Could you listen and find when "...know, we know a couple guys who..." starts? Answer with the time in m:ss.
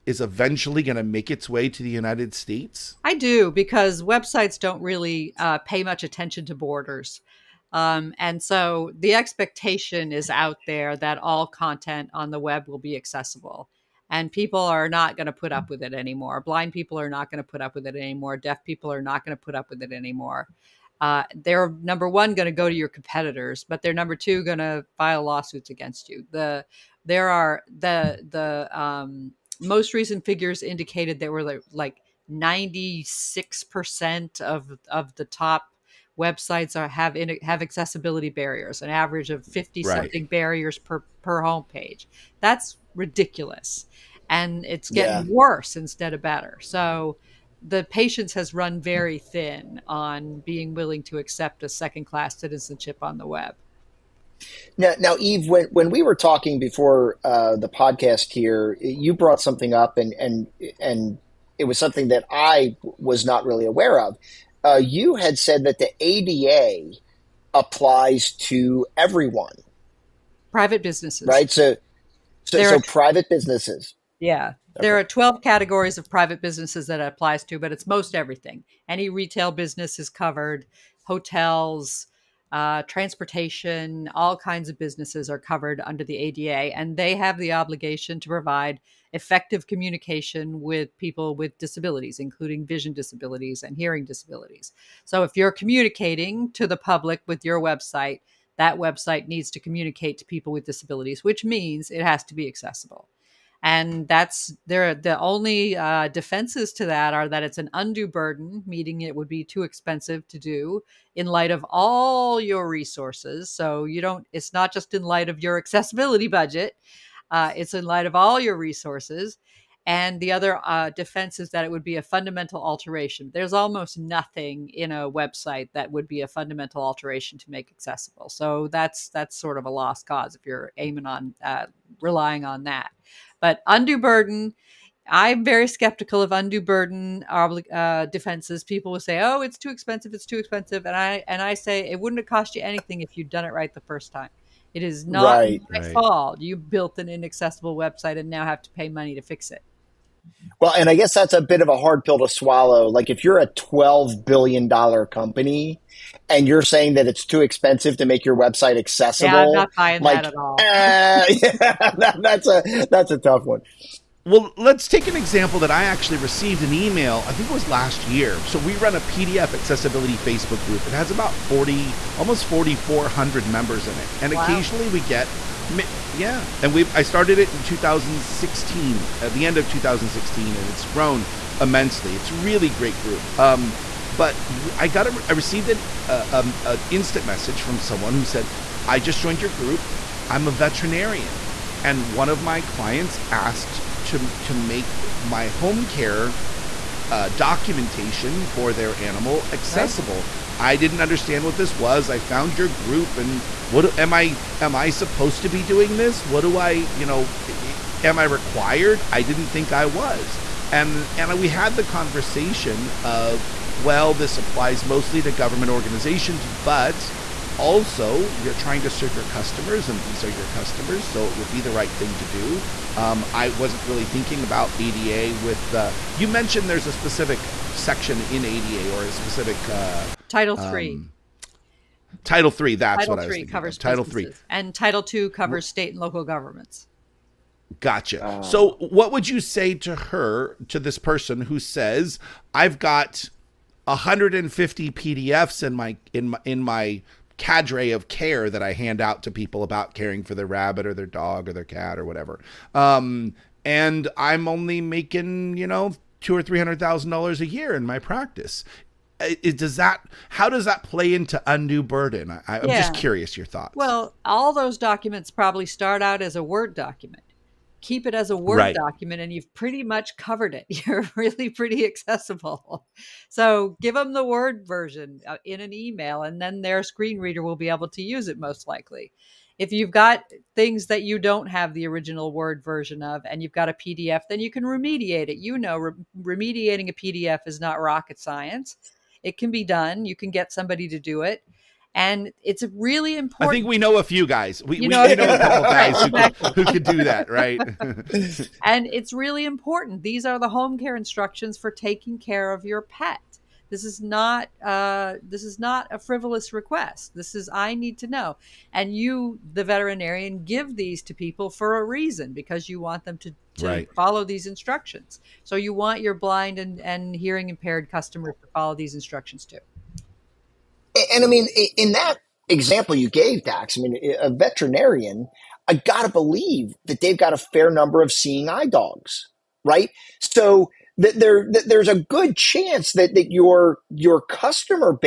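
4:54.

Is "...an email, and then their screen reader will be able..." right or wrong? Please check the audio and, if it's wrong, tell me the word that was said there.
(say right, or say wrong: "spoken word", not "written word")
right.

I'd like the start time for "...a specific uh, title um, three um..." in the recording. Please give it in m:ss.
3:49.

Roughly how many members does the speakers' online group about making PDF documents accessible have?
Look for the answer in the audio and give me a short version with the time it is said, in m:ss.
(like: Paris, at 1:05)
4,400, at 2:52.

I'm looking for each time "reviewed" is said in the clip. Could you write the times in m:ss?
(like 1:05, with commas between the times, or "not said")
not said.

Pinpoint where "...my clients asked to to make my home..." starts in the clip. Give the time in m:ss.
3:12.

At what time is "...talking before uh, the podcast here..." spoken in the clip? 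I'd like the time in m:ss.
0:56.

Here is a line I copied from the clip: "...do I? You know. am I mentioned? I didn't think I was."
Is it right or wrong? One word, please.
wrong.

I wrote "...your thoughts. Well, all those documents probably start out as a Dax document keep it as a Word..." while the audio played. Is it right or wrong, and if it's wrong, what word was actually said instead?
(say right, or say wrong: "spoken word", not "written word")
wrong: "Word", not "Dax".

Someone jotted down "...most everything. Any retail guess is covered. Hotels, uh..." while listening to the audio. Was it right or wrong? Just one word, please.
wrong.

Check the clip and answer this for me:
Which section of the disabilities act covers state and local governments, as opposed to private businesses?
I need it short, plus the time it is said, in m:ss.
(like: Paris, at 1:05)
Title 2, at 3:54.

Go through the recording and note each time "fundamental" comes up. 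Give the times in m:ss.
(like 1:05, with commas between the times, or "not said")
2:02, 2:06.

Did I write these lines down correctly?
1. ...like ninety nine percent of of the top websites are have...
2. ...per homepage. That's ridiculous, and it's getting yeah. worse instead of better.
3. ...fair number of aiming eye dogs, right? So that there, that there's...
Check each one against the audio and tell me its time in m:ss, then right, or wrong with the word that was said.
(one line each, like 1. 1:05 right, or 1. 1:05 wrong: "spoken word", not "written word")
1. 0:31 wrong: "six", not "nine"
2. 0:41 right
3. 5:27 wrong: "seeing", not "aiming".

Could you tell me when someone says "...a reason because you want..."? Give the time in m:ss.
5:11.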